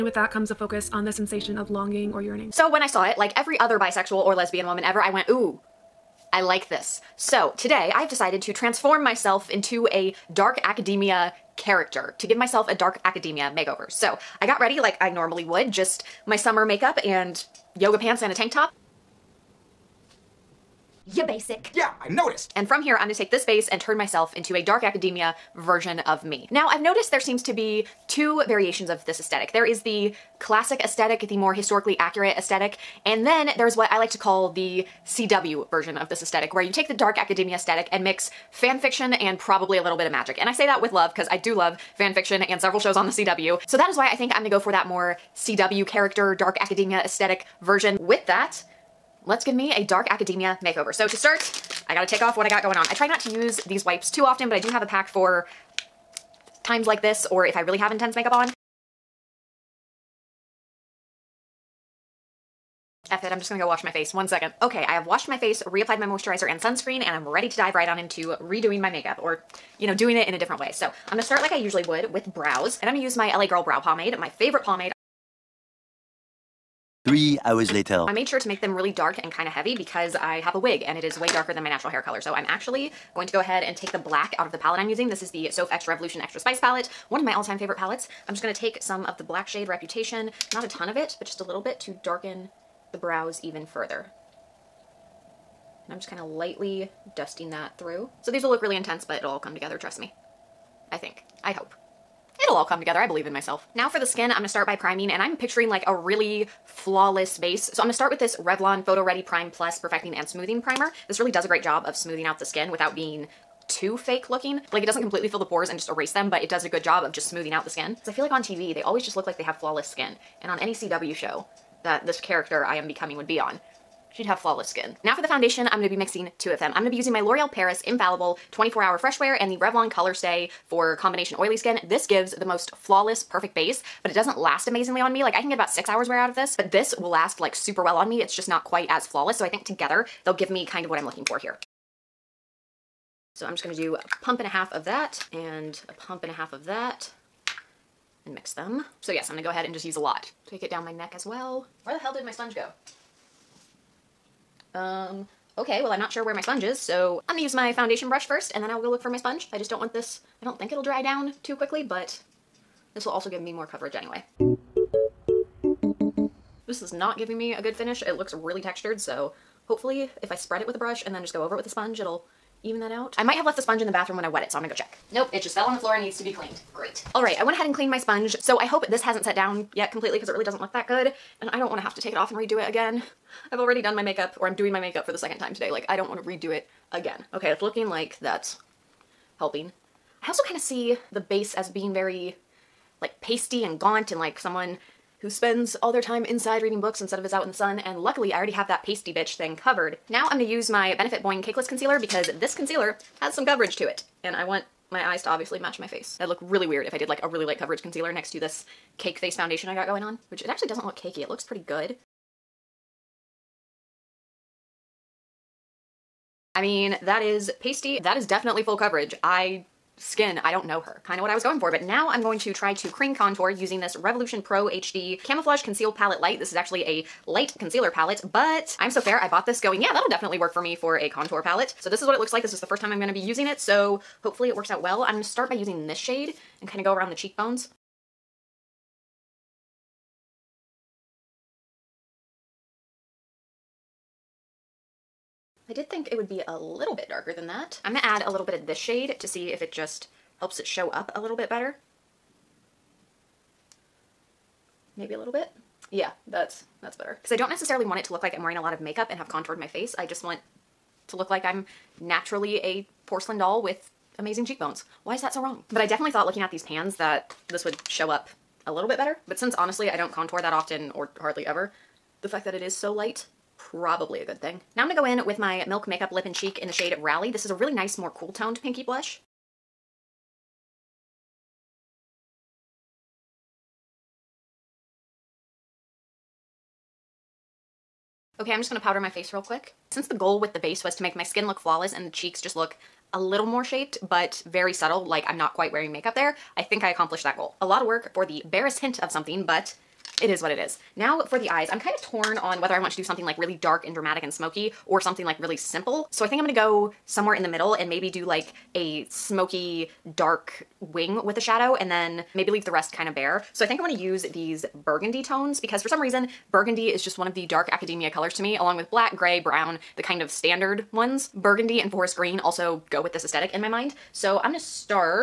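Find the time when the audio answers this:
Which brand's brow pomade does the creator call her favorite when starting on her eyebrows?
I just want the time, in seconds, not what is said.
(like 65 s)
73 s.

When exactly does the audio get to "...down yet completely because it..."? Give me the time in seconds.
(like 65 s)
179 s.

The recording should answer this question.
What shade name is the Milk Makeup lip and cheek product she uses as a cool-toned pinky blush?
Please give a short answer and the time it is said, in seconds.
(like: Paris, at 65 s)
Rally, at 277 s.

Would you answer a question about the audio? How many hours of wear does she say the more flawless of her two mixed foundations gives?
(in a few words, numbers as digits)
6.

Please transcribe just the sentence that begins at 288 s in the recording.
Okay, I'm just gonna powder my face real quick.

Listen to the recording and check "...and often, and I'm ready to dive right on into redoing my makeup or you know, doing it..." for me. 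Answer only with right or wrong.
wrong.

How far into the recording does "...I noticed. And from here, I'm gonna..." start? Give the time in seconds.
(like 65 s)
21 s.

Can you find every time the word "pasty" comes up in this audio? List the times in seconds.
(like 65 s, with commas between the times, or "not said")
193 s, 198 s, 217 s.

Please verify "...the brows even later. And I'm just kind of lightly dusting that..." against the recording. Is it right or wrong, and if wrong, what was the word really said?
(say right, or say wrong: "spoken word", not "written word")
wrong: "further", not "later".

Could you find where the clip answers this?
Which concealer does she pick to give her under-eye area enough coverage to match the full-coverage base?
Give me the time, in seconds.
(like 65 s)
200 s.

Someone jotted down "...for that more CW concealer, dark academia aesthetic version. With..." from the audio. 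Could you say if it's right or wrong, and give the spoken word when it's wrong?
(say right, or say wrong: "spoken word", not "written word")
wrong: "character", not "concealer".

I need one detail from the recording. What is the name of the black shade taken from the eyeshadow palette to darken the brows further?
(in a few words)
Reputation.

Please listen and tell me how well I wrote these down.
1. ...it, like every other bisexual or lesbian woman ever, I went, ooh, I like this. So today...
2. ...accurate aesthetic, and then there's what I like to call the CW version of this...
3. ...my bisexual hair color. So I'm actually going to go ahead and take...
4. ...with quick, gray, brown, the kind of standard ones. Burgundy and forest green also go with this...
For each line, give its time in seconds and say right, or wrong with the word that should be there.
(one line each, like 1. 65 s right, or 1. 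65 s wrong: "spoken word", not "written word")
1. 3 s right
2. 31 s right
3. 81 s wrong: "natural", not "bisexual"
4. 318 s wrong: "black", not "quick".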